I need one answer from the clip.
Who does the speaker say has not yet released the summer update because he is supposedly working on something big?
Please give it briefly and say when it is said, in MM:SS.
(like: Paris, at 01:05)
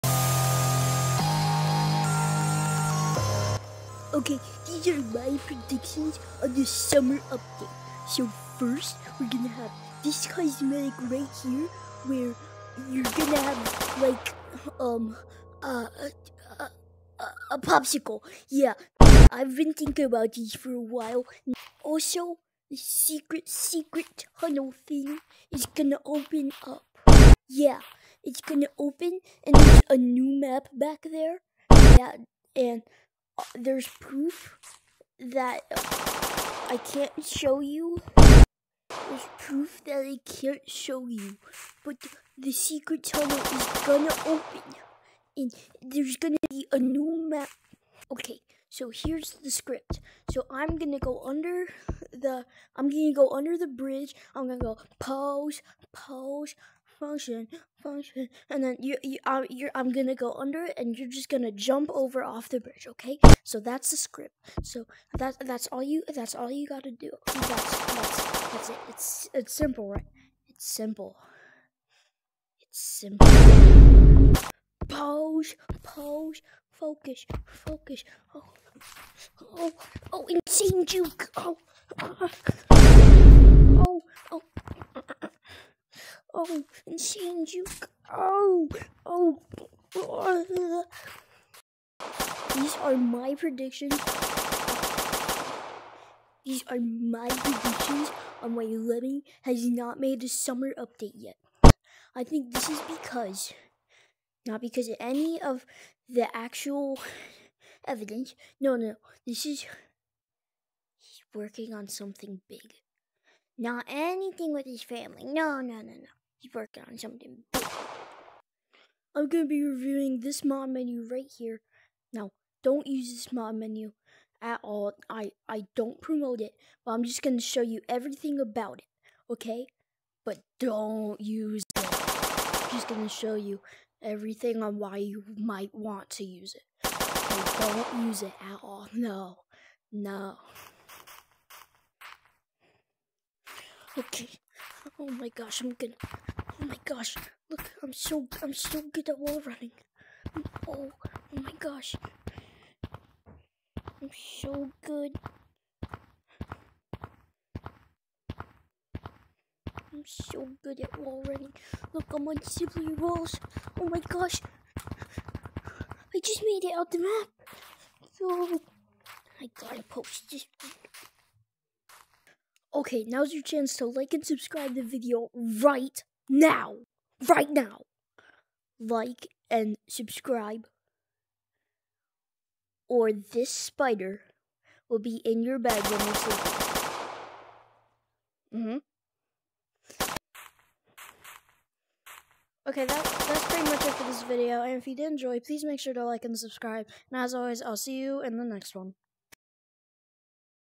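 Lemming, at 01:38.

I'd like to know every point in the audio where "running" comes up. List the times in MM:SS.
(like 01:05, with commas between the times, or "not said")
02:29, 02:41.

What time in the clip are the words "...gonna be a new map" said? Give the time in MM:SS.
00:46.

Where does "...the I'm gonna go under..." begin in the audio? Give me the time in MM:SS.
00:52.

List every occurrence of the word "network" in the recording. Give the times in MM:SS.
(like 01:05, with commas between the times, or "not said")
not said.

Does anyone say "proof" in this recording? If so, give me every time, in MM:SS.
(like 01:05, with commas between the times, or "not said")
00:33, 00:39.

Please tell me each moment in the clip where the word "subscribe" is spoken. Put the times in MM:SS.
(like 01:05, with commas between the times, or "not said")
02:54, 02:59, 03:16.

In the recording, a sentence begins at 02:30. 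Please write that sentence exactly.
Oh, oh my gosh, I'm so good.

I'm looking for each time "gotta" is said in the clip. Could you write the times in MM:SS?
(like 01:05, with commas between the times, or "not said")
01:06, 02:49.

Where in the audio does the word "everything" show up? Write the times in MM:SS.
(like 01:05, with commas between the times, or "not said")
02:07, 02:14.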